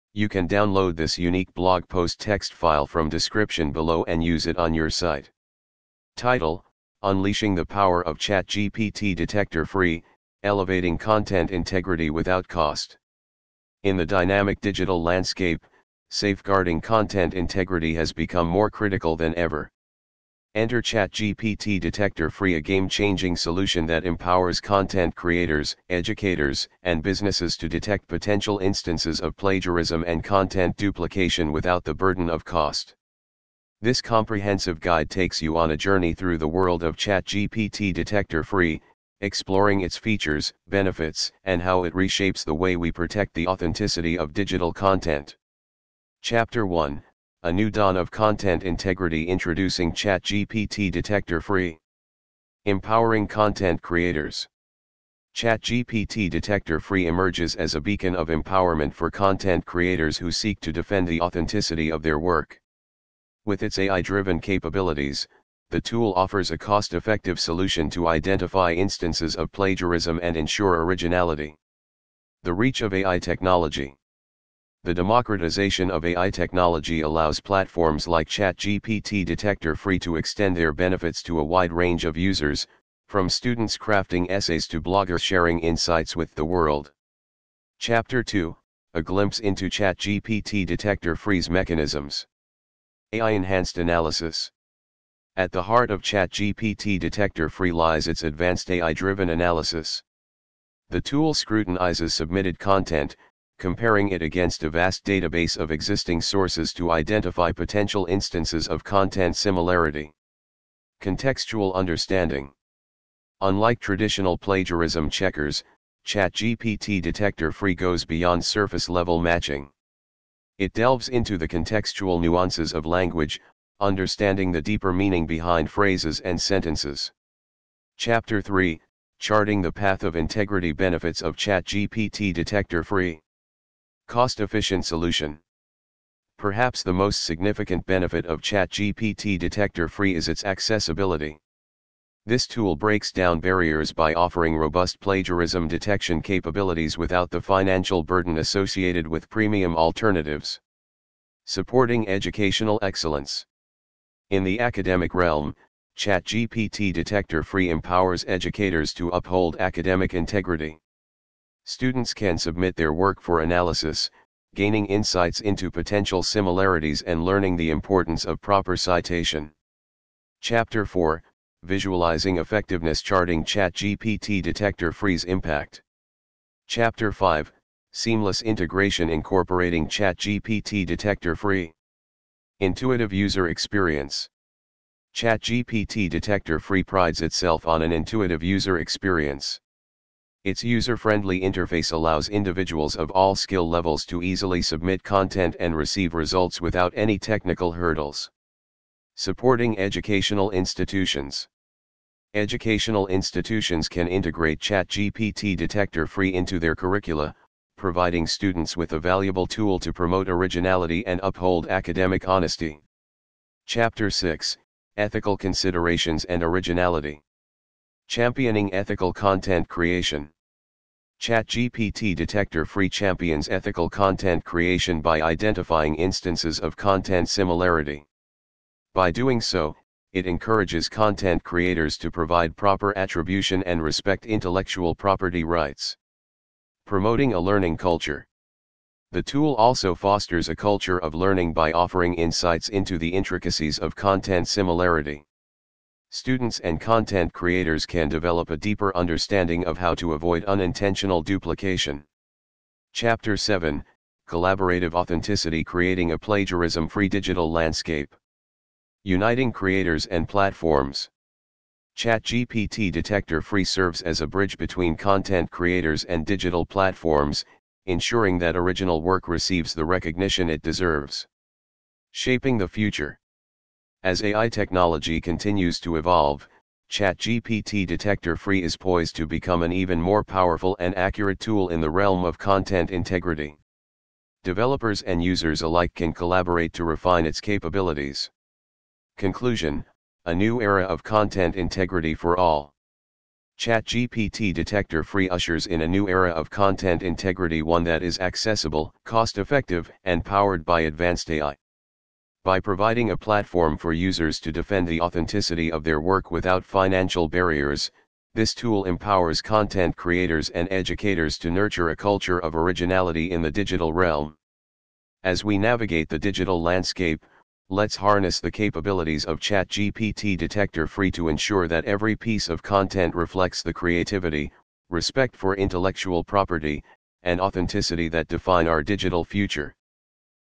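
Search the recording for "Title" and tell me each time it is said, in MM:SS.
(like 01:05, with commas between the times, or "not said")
00:06.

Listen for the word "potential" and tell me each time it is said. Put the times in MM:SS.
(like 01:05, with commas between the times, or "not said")
00:28, 01:47, 02:45.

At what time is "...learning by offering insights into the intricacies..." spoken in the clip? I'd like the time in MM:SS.
04:01.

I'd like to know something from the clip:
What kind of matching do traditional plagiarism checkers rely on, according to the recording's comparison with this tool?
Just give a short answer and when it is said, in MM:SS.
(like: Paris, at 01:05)
surface level matching, at 01:58.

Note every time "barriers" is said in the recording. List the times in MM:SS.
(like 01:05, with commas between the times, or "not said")
02:23, 05:07.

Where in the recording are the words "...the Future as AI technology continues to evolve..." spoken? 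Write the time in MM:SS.
04:32.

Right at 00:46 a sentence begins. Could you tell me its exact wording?
Chapter 1 a new dawn of content integrity introducing ChatGPT Detector Free.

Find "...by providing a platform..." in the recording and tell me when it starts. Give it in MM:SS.
05:02.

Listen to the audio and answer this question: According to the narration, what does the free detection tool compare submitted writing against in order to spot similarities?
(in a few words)
a vast database of existing sources.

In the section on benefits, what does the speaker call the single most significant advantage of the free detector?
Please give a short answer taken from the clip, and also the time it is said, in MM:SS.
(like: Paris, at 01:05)
its accessibility, at 02:20.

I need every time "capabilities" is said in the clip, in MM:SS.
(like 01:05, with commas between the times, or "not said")
01:04, 02:26, 04:47, 05:18.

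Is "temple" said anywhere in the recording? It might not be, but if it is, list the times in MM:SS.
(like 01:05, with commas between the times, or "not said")
not said.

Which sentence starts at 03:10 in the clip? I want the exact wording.
Its user-friendly interface allows individuals of all skill levels to easily submit content and receive results without any technical hurdles.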